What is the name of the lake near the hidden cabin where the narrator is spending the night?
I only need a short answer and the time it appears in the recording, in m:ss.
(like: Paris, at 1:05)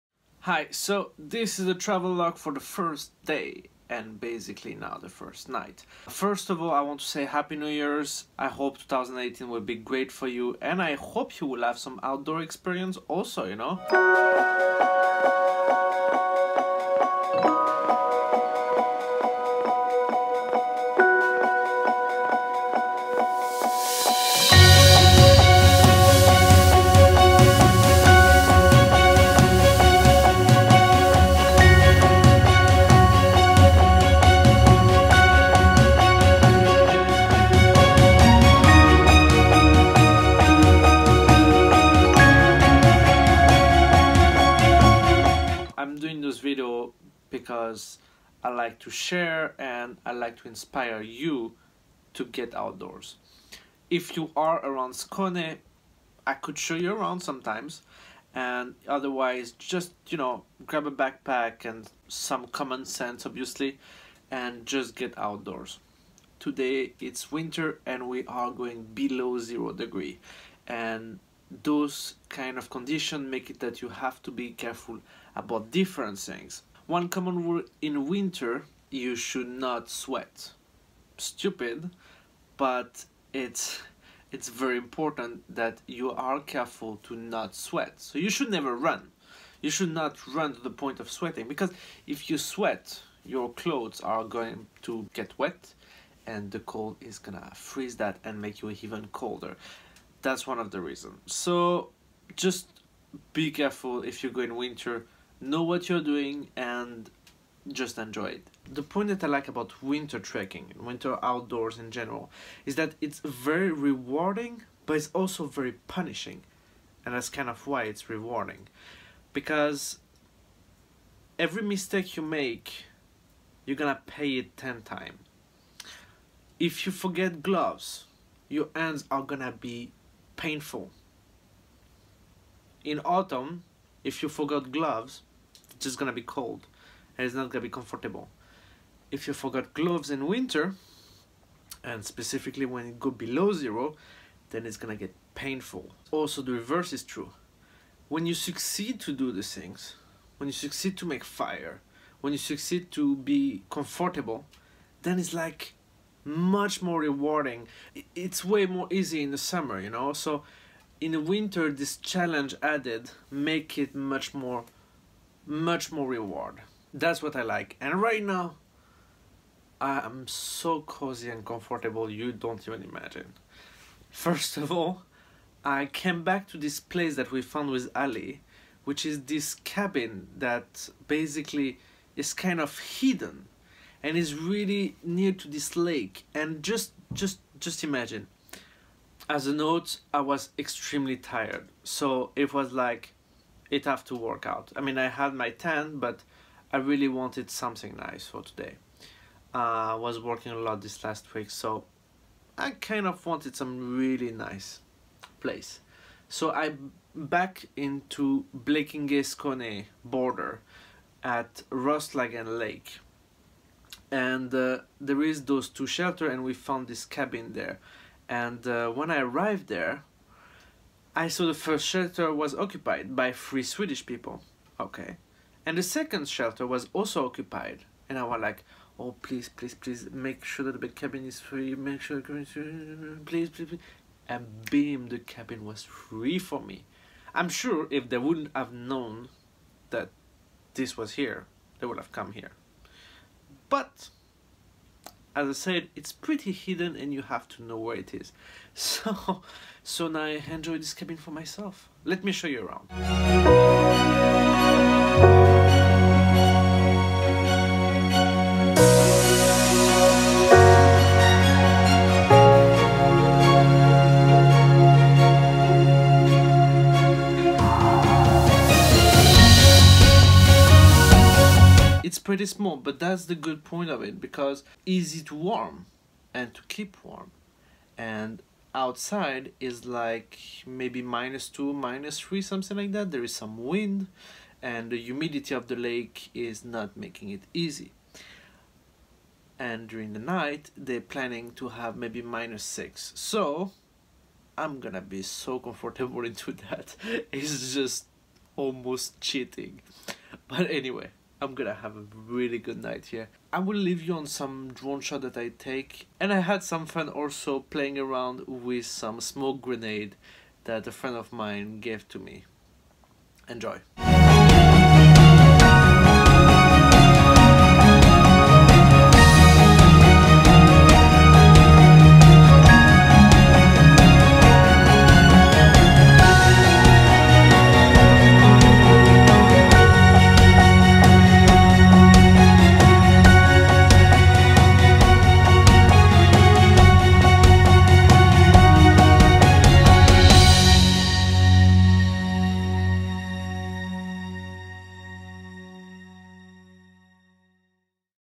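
Rostlagen Lake, at 3:31.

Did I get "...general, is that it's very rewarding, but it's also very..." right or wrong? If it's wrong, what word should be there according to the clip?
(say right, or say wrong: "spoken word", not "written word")
right.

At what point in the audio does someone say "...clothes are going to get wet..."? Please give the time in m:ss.
1:33.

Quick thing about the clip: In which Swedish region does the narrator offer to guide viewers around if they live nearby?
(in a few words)
Skåne.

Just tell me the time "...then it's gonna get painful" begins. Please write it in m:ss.
2:24.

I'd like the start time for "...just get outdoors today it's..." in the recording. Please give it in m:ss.
1:04.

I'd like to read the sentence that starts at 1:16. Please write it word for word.
One common rule in winter, you should not sweat.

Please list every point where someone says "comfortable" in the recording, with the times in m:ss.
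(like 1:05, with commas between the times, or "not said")
2:17, 2:33, 2:51, 4:55.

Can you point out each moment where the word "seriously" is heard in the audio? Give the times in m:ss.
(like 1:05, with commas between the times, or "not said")
not said.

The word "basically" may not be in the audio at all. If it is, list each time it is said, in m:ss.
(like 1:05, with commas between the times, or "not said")
0:04, 3:01.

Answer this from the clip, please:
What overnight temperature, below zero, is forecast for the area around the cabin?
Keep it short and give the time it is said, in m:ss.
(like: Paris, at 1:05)
-6, at 4:52.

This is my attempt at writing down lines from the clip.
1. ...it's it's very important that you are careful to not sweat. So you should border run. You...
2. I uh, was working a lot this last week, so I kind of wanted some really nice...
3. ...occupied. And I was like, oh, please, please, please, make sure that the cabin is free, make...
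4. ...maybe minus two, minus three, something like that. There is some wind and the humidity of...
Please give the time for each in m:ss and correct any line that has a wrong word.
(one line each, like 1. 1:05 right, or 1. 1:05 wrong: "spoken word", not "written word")
1. 1:23 wrong: "never", not "border"
2. 3:19 right
3. 3:47 right
4. 4:40 right.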